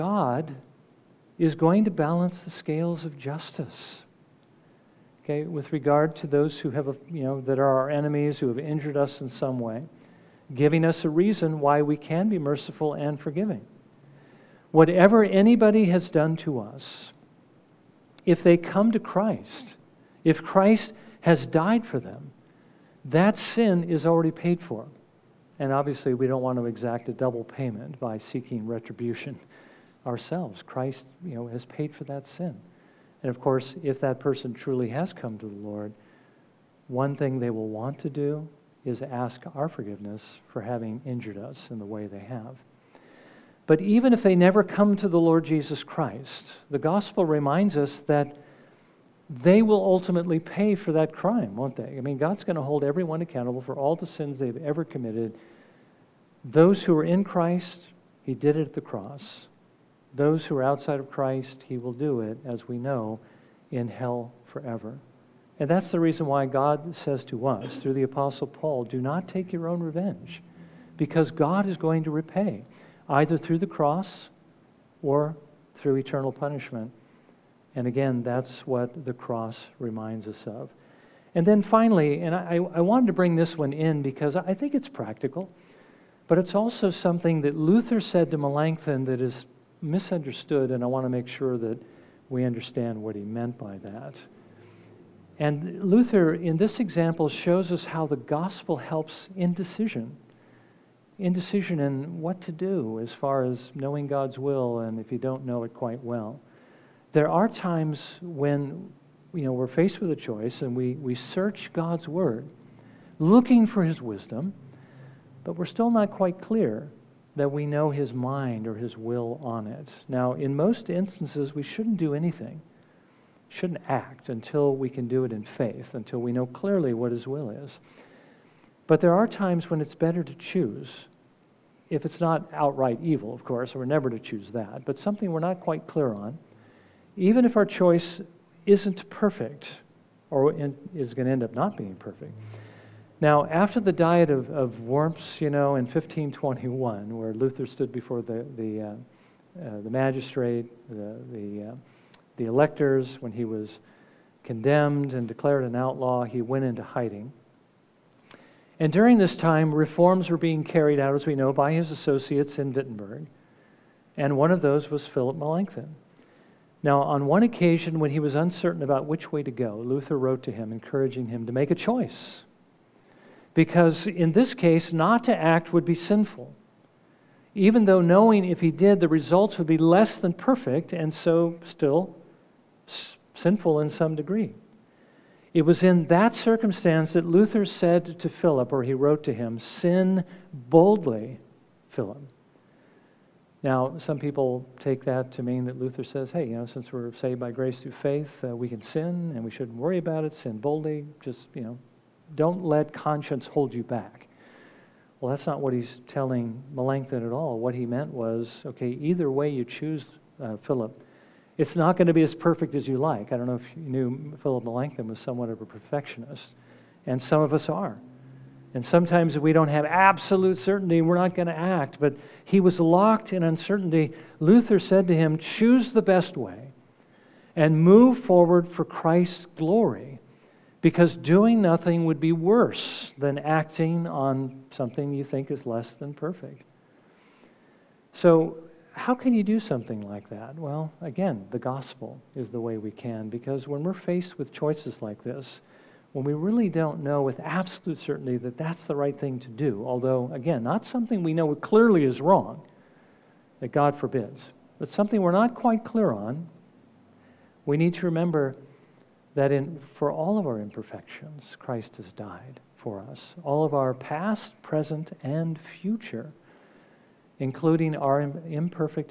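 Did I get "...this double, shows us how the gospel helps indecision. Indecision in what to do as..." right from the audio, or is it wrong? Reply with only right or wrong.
wrong.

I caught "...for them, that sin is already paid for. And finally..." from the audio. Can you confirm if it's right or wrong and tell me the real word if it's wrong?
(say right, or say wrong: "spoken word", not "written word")
wrong: "obviously", not "finally".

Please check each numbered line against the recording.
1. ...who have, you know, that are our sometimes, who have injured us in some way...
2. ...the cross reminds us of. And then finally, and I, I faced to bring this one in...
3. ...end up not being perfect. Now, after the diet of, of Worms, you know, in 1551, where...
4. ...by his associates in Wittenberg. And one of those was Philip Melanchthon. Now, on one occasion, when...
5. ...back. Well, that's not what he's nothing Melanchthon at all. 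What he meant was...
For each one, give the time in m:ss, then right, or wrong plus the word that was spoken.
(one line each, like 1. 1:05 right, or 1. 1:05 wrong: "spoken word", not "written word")
1. 0:06 wrong: "enemies", not "sometimes"
2. 1:19 wrong: "wanted", not "faced"
3. 2:21 wrong: "1521", not "1551"
4. 2:41 right
5. 3:23 wrong: "telling", not "nothing".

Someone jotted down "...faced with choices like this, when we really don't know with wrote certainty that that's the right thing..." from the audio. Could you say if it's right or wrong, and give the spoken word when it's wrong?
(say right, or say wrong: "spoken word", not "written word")
wrong: "absolute", not "wrote".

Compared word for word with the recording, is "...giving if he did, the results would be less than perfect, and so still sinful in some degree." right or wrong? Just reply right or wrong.
wrong.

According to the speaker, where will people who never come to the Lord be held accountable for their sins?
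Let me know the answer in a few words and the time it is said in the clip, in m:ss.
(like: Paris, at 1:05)
In hell forever, at 1:03.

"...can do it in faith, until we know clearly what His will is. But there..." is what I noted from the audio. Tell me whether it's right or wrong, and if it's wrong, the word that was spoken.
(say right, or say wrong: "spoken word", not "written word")
right.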